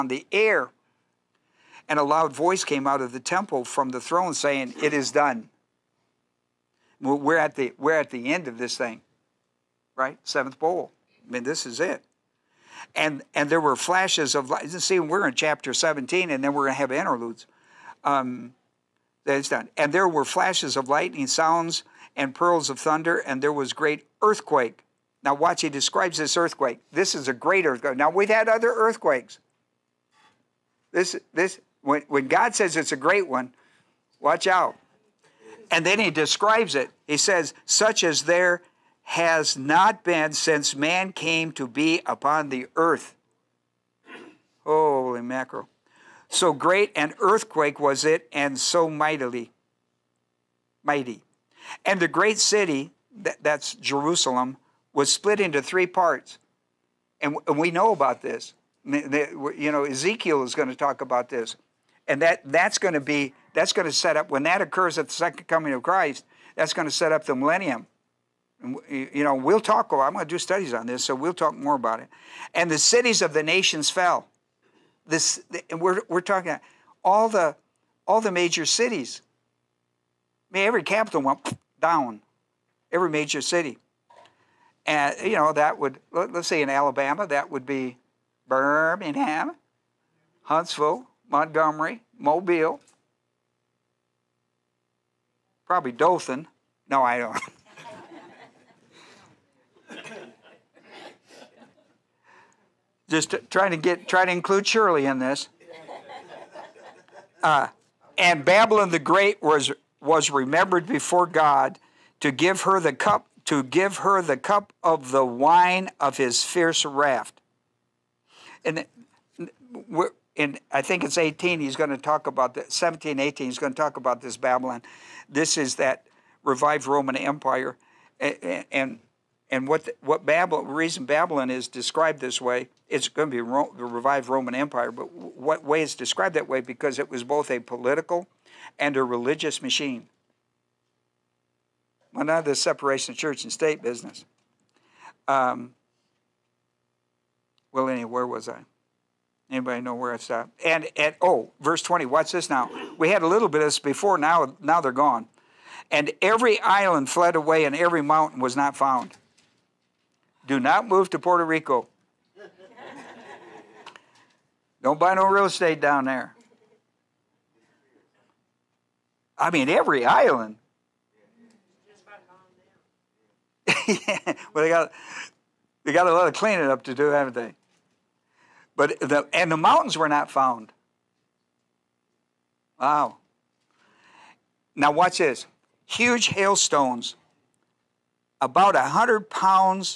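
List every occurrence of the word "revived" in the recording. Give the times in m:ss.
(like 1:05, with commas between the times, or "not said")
2:06, 2:13.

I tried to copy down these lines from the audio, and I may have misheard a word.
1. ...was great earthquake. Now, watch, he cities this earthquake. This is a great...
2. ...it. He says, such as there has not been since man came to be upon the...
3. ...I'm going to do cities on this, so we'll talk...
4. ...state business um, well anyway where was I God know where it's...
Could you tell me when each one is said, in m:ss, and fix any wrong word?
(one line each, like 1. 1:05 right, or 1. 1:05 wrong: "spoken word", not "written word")
1. 0:23 wrong: "describes", not "cities"
2. 0:36 right
3. 1:09 wrong: "studies", not "cities"
4. 2:23 wrong: "Anybody", not "God".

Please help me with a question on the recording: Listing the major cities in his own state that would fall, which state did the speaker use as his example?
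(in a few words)
Alabama.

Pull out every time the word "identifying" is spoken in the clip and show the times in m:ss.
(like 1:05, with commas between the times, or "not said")
not said.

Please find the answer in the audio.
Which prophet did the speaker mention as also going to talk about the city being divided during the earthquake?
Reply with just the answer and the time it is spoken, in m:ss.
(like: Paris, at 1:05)
Ezekiel, at 0:59.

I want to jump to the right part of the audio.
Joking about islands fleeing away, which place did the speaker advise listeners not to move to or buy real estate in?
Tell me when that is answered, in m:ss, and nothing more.
2:41.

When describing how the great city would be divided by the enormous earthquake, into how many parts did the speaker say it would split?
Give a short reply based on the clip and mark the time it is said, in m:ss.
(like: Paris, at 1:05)
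3, at 0:55.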